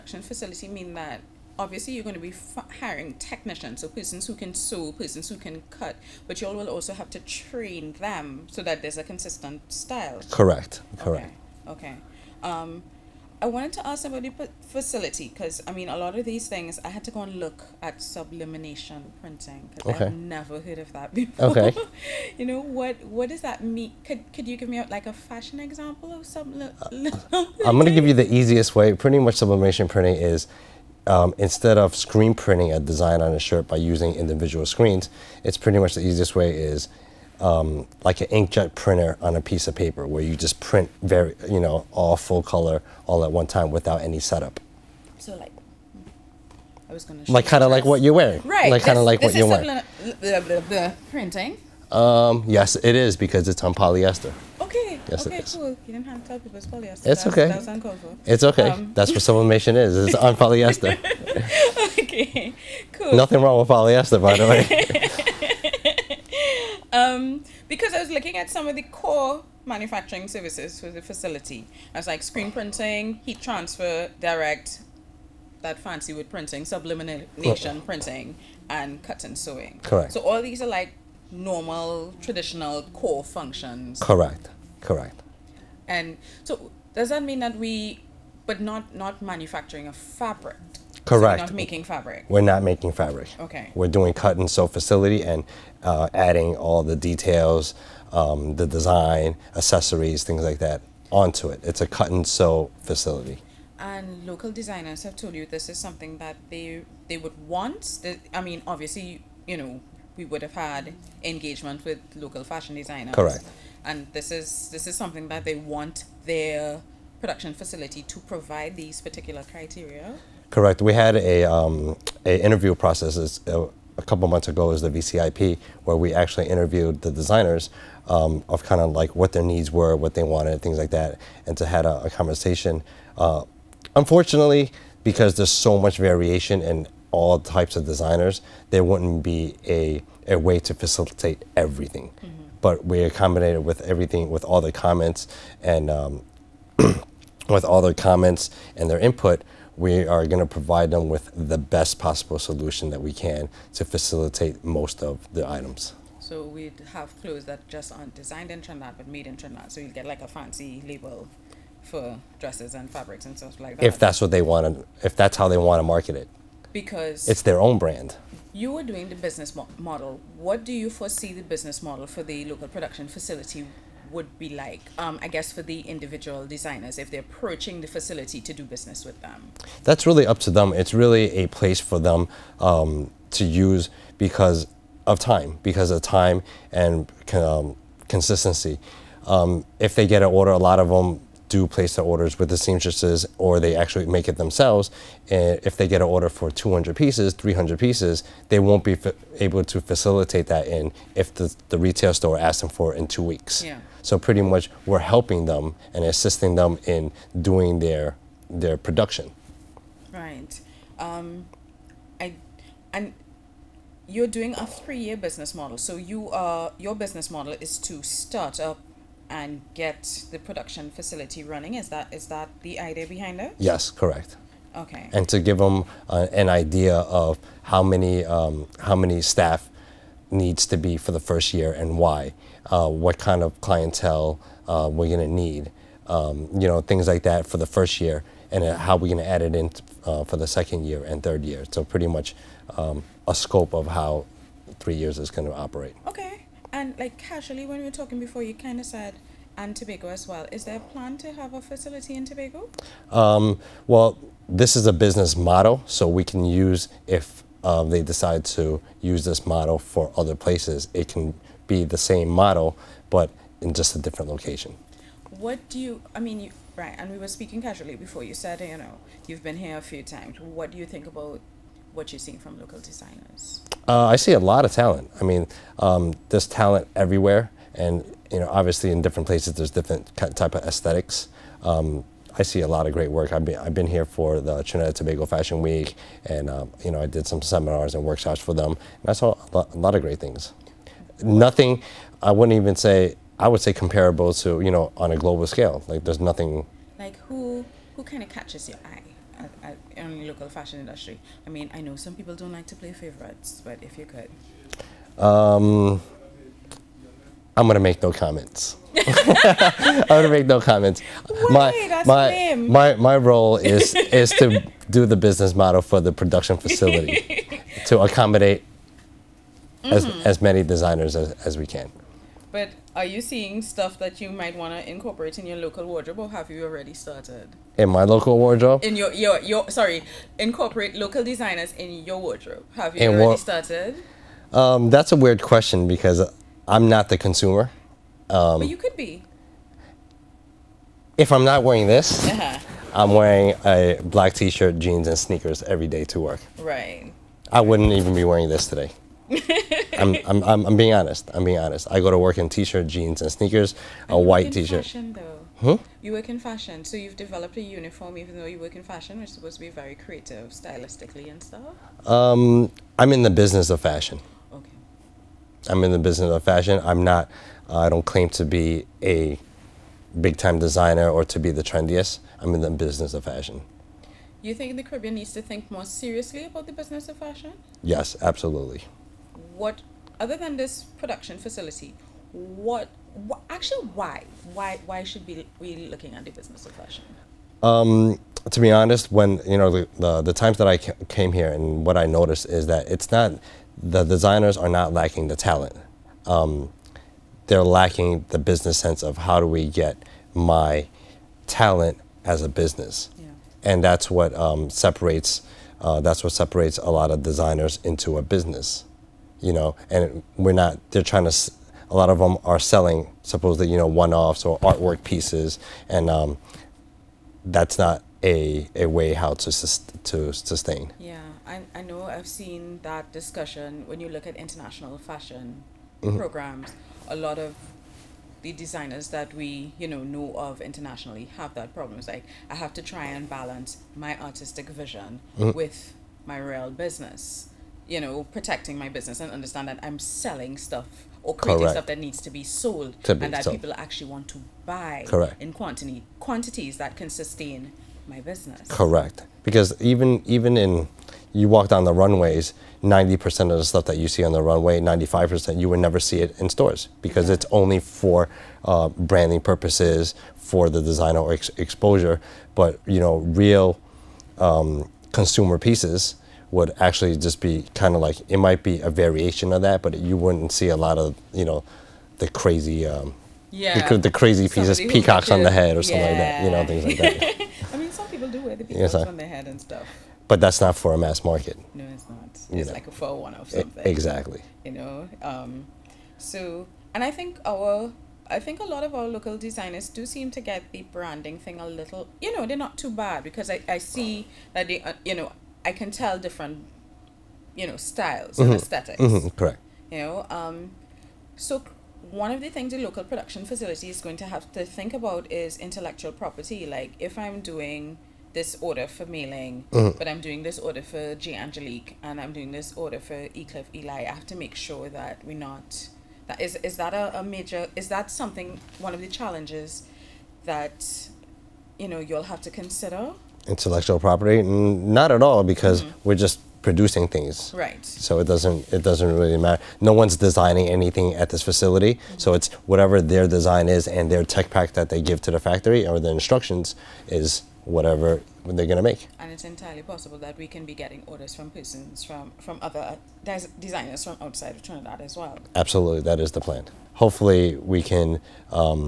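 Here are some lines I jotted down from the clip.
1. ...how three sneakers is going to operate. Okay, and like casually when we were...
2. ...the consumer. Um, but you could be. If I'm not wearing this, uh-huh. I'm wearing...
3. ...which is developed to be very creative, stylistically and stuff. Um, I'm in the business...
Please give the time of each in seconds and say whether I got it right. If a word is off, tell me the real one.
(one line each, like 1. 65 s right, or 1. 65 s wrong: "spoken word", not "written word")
1. 243 s wrong: "years", not "sneakers"
2. 337 s right
3. 359 s wrong: "supposed", not "developed".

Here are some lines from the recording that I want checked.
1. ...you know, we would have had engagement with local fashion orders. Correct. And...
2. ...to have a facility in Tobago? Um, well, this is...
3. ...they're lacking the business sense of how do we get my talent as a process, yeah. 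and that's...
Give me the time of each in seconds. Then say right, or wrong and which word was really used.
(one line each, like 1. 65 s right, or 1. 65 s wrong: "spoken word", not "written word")
1. 109 s wrong: "designers", not "orders"
2. 251 s right
3. 397 s wrong: "business", not "process".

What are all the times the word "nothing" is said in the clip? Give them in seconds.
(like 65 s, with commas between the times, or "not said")
63 s, 291 s, 296 s.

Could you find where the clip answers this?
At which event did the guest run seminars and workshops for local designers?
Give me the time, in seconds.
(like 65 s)
284 s.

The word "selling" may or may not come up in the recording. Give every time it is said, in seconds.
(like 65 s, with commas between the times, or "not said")
412 s, 439 s.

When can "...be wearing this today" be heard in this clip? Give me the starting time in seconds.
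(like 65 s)
348 s.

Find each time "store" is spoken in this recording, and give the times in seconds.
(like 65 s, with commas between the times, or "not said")
202 s, 456 s.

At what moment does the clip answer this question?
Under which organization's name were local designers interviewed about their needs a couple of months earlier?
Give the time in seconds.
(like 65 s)
124 s.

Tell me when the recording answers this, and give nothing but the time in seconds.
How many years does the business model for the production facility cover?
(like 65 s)
214 s.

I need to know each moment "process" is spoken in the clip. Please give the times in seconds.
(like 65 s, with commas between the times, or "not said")
122 s.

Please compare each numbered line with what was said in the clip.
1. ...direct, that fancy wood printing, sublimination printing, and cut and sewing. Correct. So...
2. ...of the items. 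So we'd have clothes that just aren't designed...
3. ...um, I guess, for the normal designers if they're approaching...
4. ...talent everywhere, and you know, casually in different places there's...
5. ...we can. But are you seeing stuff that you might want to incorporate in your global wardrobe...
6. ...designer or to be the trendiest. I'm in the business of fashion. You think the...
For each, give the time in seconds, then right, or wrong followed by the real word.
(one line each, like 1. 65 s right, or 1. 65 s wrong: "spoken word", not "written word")
1. 74 s right
2. 155 s right
3. 174 s wrong: "individual", not "normal"
4. 276 s wrong: "obviously", not "casually"
5. 321 s wrong: "local", not "global"
6. 370 s right.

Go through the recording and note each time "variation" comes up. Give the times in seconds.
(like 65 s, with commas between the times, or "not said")
135 s, 468 s.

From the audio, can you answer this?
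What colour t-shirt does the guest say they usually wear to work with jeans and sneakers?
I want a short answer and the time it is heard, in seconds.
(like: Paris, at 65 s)
white, at 354 s.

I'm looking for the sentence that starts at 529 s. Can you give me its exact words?
No one's designing anything at this facility.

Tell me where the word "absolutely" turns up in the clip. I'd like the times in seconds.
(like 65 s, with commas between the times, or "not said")
378 s, 545 s.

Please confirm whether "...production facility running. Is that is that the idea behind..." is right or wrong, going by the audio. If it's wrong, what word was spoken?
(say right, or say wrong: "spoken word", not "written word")
right.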